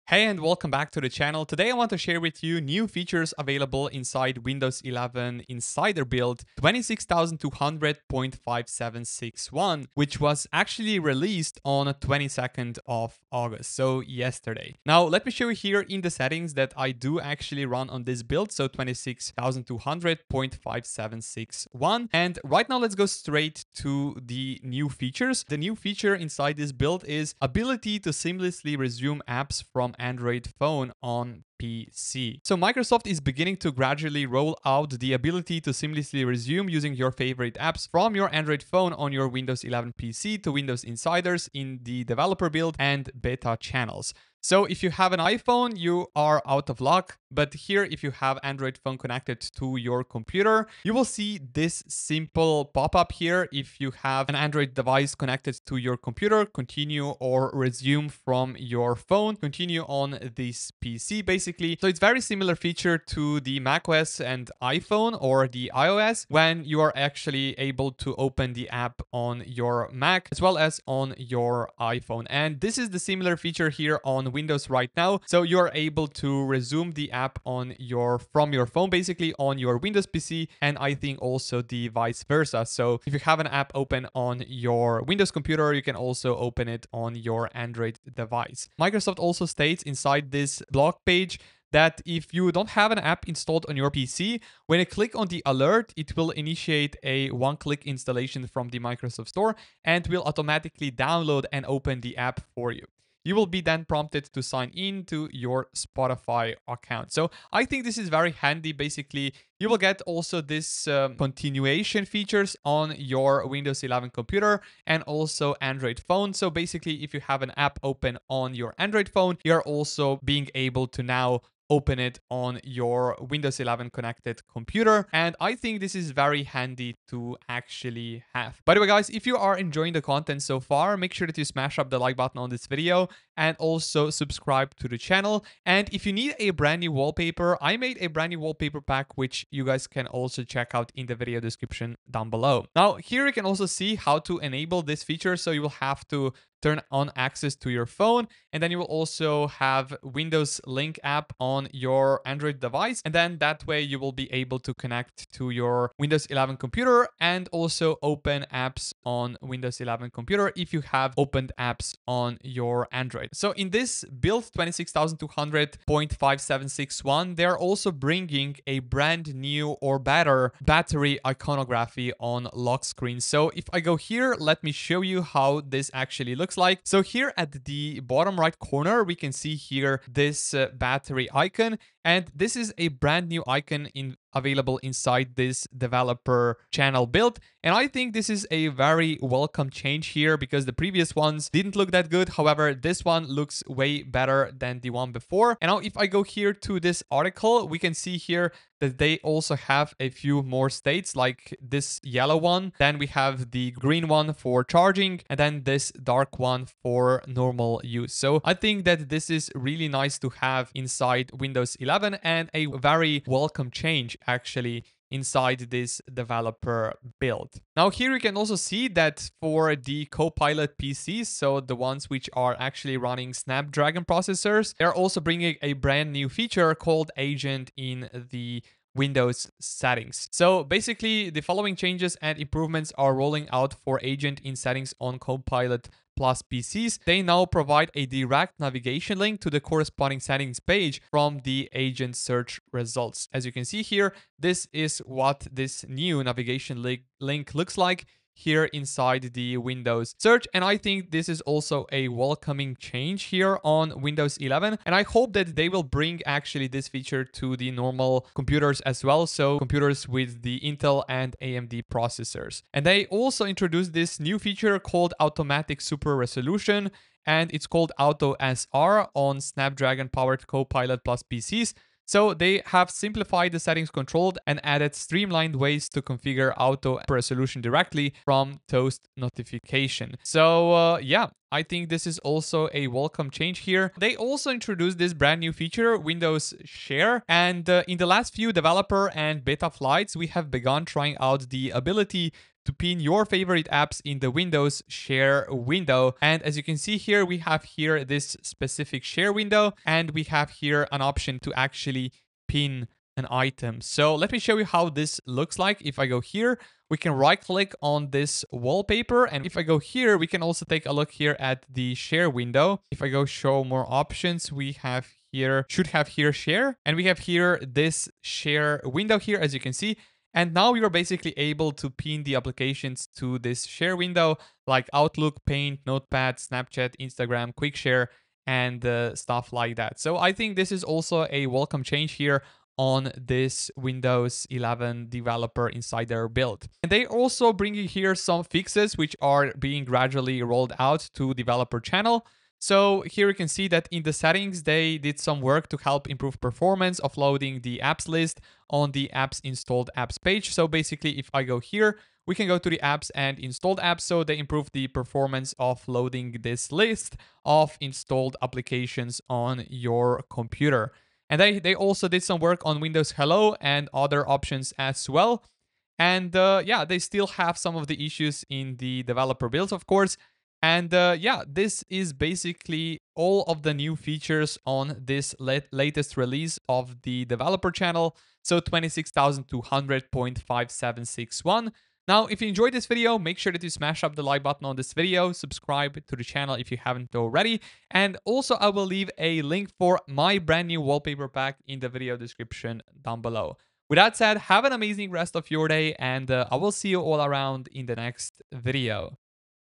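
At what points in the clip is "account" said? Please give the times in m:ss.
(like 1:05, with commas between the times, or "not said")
1:46.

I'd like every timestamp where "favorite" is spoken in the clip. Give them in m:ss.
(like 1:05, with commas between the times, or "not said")
0:37, 4:53.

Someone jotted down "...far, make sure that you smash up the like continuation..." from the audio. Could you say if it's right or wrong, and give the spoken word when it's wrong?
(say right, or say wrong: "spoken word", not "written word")
wrong: "button", not "continuation".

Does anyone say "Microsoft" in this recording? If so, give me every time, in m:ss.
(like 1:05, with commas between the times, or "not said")
0:32, 1:28, 1:38.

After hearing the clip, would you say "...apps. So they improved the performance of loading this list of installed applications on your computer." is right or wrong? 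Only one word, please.
right.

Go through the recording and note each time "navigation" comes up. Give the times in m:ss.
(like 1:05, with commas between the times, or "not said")
3:58, 4:06.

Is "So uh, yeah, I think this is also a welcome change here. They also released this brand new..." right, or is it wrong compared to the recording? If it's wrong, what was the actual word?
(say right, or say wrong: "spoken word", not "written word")
wrong: "introduced", not "released".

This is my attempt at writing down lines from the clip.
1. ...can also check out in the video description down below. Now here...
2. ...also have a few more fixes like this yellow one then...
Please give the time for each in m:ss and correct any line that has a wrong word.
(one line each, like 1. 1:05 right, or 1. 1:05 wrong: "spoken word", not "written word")
1. 2:19 right
2. 3:19 wrong: "states", not "fixes".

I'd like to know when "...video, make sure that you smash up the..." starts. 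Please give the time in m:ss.
6:22.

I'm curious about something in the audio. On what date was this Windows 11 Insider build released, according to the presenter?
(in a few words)
22nd of August.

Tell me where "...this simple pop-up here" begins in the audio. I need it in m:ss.
0:51.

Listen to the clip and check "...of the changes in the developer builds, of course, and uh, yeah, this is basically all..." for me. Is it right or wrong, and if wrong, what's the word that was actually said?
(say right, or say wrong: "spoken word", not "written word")
wrong: "issues", not "changes".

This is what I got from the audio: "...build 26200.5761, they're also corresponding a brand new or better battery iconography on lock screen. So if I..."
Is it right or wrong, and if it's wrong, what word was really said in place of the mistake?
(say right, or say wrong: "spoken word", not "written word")
wrong: "bringing", not "corresponding".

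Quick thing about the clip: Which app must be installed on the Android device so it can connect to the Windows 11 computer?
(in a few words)
Windows Link.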